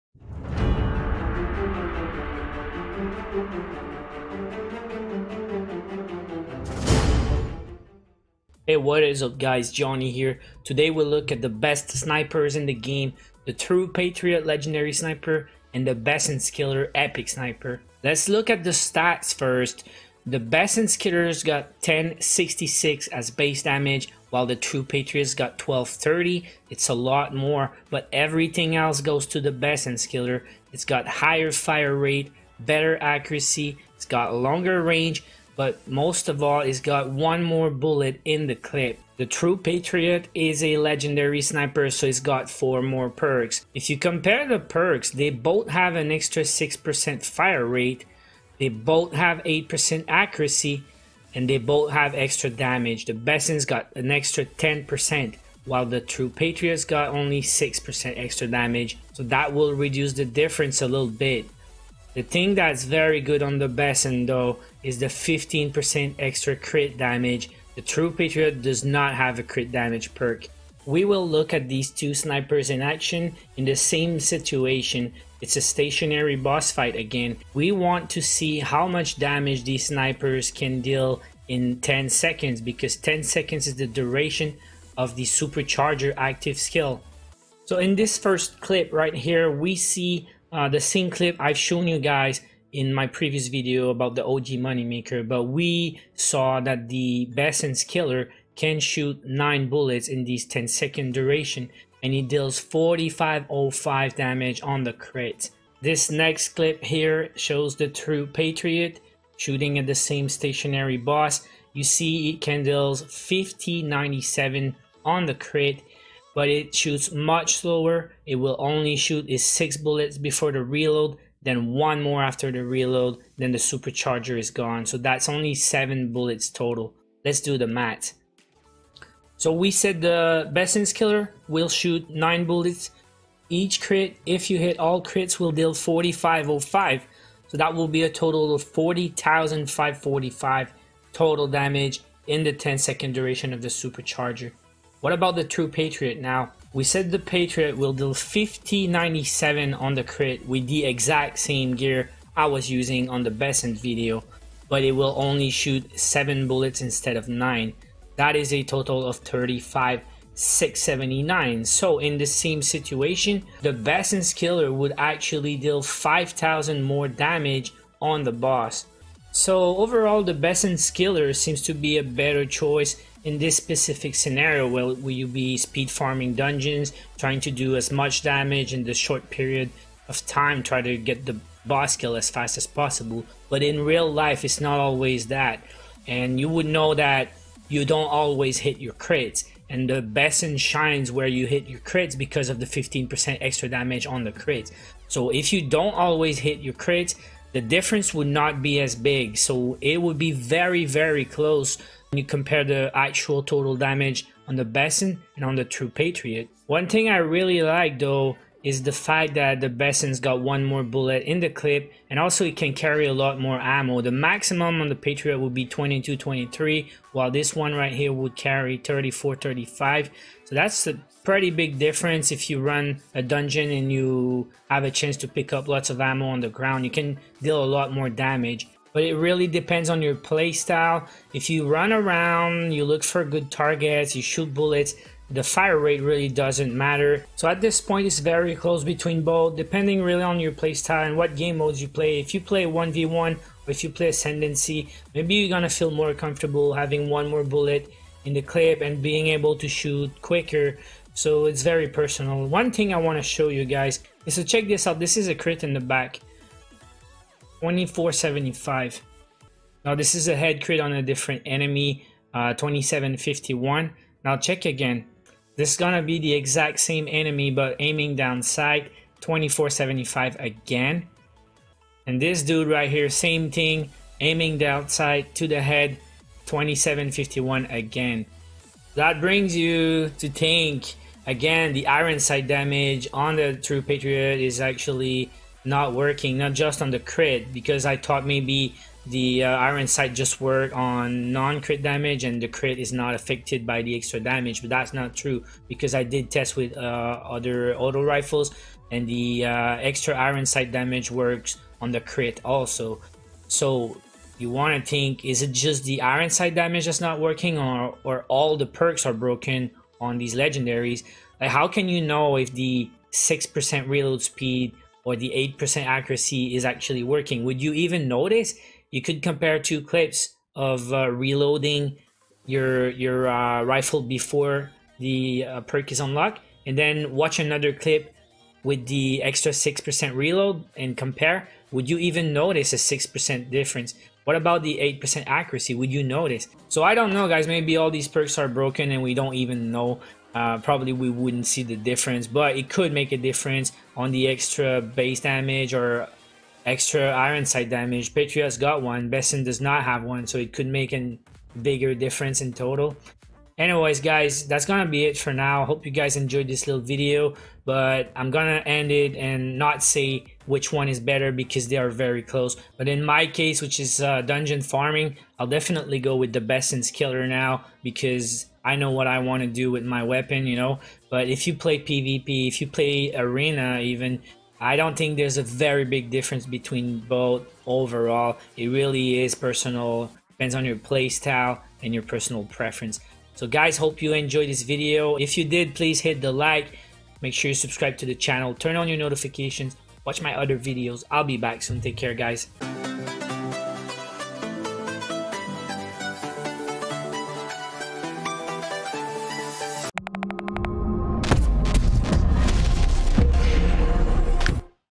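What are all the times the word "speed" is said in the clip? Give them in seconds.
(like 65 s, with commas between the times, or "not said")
175 s, 314 s.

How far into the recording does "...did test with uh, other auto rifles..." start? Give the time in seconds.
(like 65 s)
296 s.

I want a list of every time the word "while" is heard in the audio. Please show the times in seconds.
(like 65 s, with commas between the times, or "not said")
24 s, 55 s, 217 s.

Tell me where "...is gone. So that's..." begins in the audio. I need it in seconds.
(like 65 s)
124 s.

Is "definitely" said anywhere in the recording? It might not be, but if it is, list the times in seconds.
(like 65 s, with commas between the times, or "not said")
365 s.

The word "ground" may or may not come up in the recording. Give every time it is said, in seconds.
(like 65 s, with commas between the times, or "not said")
226 s.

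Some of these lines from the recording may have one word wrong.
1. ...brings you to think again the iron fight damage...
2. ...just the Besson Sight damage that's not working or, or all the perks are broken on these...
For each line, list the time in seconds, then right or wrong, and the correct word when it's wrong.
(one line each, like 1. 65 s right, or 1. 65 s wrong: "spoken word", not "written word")
1. 279 s wrong: "sight", not "fight"
2. 305 s wrong: "Iron", not "Besson".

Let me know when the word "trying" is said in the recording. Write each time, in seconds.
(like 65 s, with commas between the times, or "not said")
177 s.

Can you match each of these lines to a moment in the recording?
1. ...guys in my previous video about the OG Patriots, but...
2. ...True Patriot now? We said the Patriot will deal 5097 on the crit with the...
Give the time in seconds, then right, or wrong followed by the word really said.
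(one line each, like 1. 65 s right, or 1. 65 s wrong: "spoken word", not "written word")
1. 91 s wrong: "Moneymaker", not "Patriots"
2. 145 s right.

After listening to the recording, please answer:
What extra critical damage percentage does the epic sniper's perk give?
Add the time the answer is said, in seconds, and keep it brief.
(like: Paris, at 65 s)
15%, at 65 s.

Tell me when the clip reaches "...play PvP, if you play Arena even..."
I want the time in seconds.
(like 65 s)
371 s.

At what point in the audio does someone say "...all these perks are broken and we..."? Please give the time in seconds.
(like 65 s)
337 s.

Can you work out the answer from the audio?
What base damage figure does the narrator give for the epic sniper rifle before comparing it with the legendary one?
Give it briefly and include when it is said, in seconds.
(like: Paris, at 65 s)
1066, at 21 s.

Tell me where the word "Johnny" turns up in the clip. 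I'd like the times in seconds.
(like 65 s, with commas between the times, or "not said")
9 s.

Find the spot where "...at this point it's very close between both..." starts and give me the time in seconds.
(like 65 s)
237 s.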